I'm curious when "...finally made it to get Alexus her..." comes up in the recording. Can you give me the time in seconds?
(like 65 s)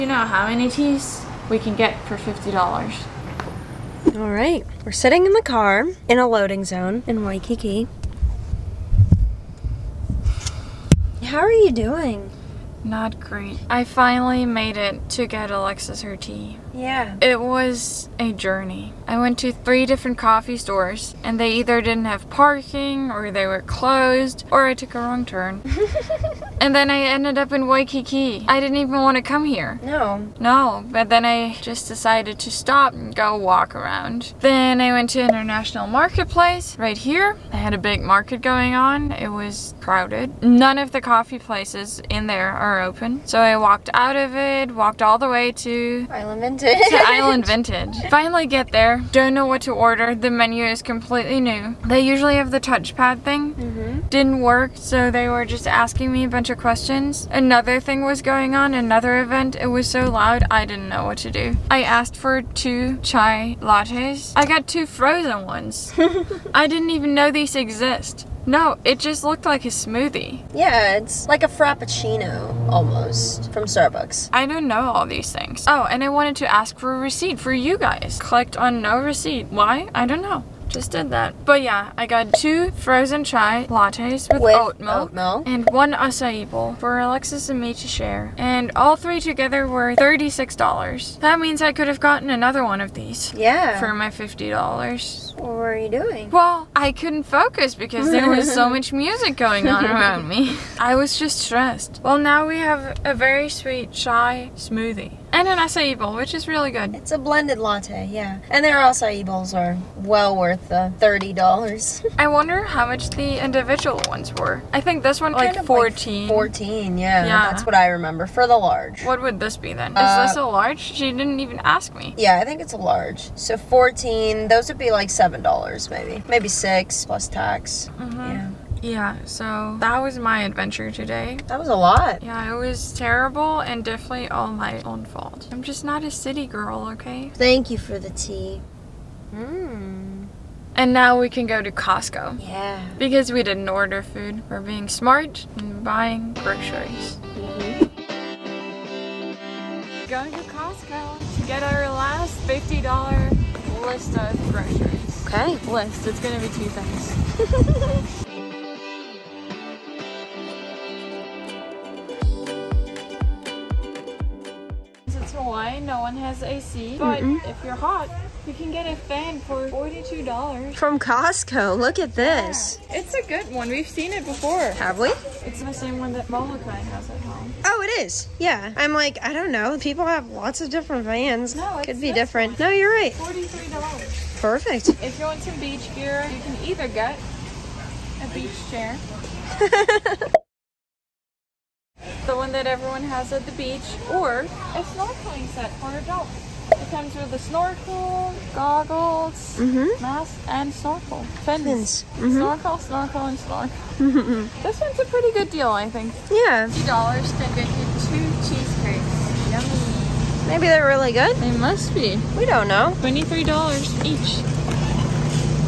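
13 s.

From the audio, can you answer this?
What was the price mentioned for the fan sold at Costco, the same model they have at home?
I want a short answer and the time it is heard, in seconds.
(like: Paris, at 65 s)
$43, at 183 s.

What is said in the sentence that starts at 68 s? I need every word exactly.
No, it just looked like a smoothie.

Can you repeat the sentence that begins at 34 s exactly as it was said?
Then I went to International Marketplace right here.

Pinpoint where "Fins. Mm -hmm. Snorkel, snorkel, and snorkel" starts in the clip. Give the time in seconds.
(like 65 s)
201 s.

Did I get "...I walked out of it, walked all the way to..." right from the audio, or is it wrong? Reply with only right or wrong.
right.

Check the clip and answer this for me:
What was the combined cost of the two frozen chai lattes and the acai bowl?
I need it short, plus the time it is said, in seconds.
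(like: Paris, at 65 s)
$36, at 89 s.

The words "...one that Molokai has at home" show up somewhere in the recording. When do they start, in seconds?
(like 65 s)
176 s.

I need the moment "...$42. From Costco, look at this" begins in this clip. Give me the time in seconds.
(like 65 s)
169 s.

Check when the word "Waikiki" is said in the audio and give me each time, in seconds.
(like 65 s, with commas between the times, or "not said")
7 s, 27 s.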